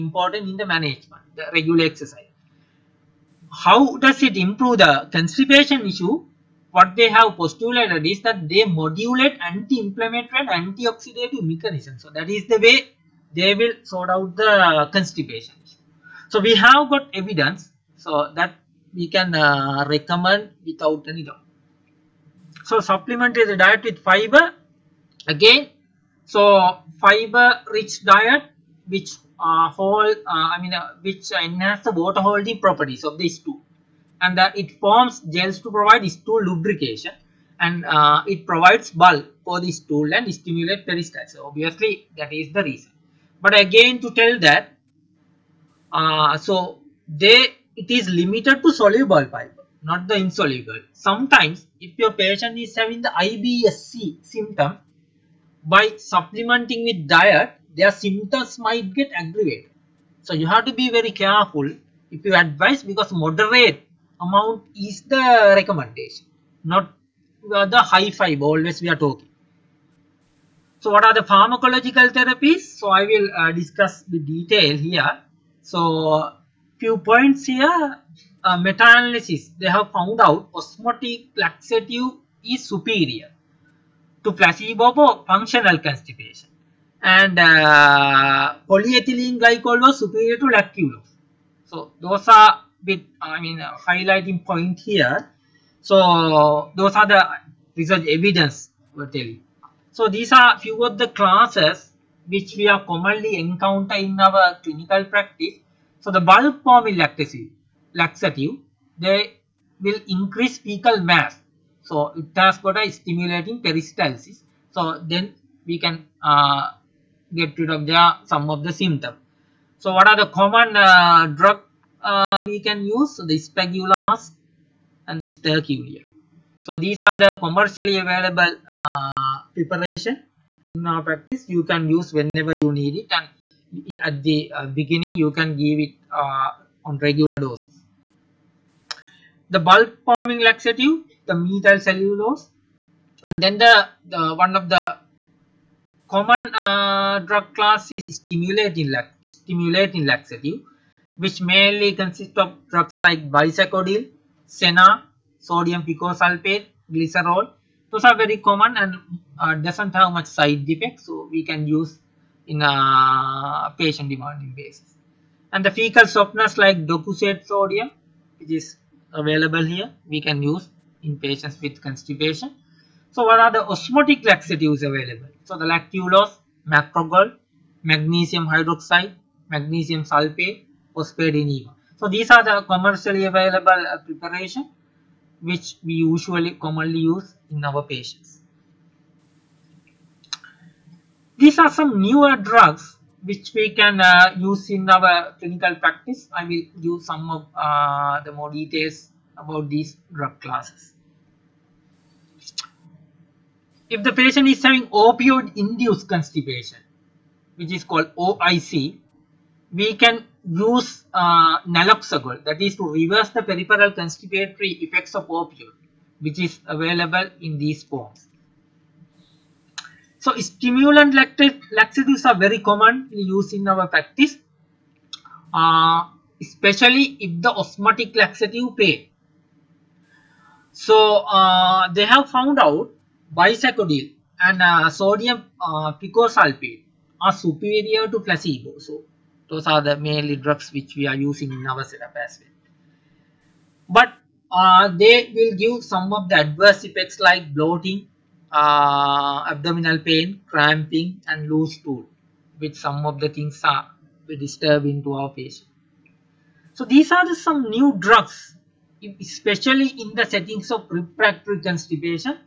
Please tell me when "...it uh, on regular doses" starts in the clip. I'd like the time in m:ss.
2:15.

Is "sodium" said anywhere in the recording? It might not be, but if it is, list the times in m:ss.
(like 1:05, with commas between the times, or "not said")
2:35, 2:47, 3:54.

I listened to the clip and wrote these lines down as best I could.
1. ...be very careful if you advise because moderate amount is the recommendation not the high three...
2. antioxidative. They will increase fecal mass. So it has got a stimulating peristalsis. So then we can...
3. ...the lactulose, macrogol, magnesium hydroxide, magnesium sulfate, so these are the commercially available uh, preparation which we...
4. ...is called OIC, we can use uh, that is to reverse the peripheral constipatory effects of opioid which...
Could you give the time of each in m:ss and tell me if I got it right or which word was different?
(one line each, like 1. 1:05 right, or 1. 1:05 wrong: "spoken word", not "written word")
1. 1:00 wrong: "five", not "three"
2. 1:47 wrong: "laxative", not "antioxidative"
3. 2:55 right
4. 3:27 right.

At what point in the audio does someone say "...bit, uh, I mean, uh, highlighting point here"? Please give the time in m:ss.
1:32.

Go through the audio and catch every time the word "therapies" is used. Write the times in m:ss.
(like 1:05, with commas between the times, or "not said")
1:12.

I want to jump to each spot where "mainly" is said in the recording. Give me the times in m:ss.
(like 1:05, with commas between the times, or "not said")
2:31, 3:59.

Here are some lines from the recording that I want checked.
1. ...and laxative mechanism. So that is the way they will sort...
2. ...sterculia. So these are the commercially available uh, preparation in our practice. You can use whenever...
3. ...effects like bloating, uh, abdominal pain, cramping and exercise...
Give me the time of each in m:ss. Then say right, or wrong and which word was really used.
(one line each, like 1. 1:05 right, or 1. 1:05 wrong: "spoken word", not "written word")
1. 0:10 wrong: "antioxidative", not "laxative"
2. 2:05 right
3. 4:06 wrong: "loose", not "exercise".